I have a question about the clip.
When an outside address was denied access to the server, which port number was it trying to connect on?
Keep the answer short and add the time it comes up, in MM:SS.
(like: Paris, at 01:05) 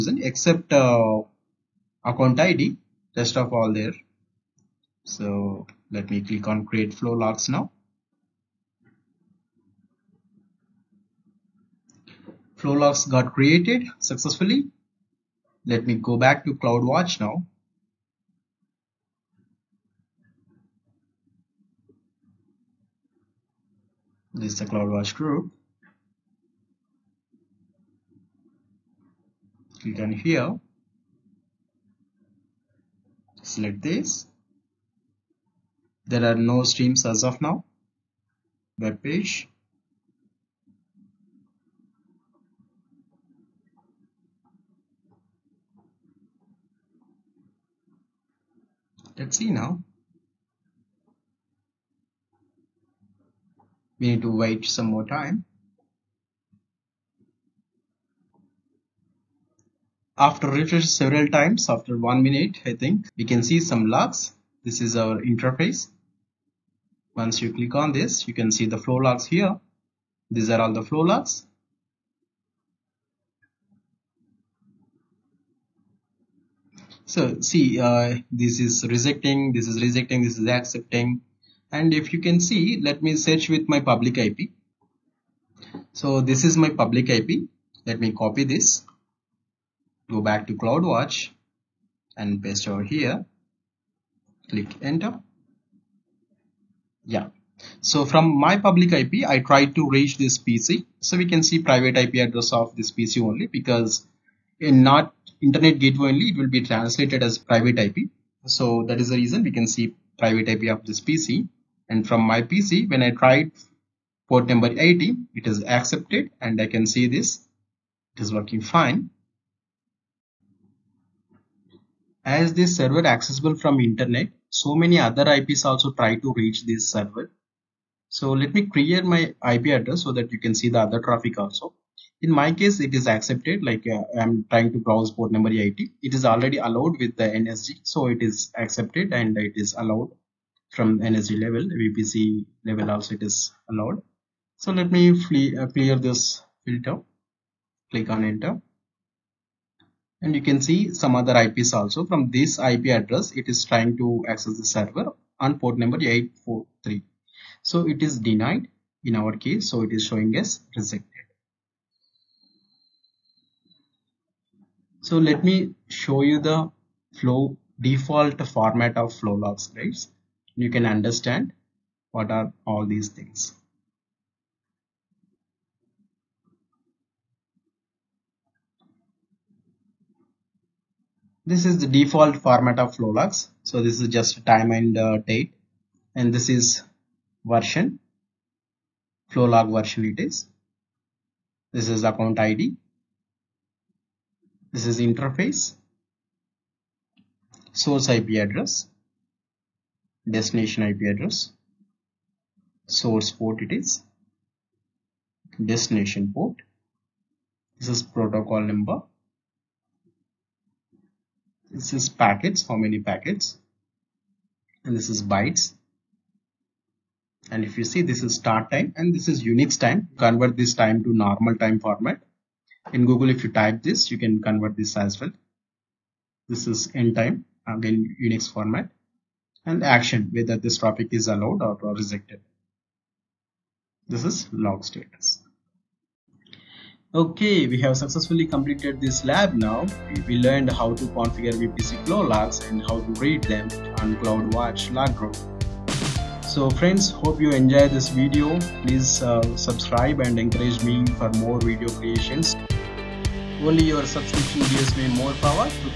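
843, at 02:36.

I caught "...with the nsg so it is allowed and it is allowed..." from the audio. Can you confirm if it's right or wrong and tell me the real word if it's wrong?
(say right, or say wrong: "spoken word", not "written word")
wrong: "accepted", not "allowed".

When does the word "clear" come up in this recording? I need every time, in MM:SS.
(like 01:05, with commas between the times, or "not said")
02:25.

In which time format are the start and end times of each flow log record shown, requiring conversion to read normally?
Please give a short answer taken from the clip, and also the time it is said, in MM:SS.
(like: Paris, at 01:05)
Unix time, at 03:39.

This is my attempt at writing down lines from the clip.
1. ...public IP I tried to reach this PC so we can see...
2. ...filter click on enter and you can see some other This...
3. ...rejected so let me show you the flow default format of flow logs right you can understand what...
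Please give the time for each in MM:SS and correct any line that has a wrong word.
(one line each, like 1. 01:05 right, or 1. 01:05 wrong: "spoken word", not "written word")
1. 01:38 right
2. 02:26 wrong: "IPs", not "This"
3. 02:40 right.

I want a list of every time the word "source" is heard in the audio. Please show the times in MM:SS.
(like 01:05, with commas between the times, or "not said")
03:17, 03:22.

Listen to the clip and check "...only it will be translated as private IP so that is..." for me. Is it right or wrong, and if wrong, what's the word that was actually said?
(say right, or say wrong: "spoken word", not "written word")
right.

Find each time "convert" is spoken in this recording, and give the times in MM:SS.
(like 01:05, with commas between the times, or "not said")
03:40, 03:44.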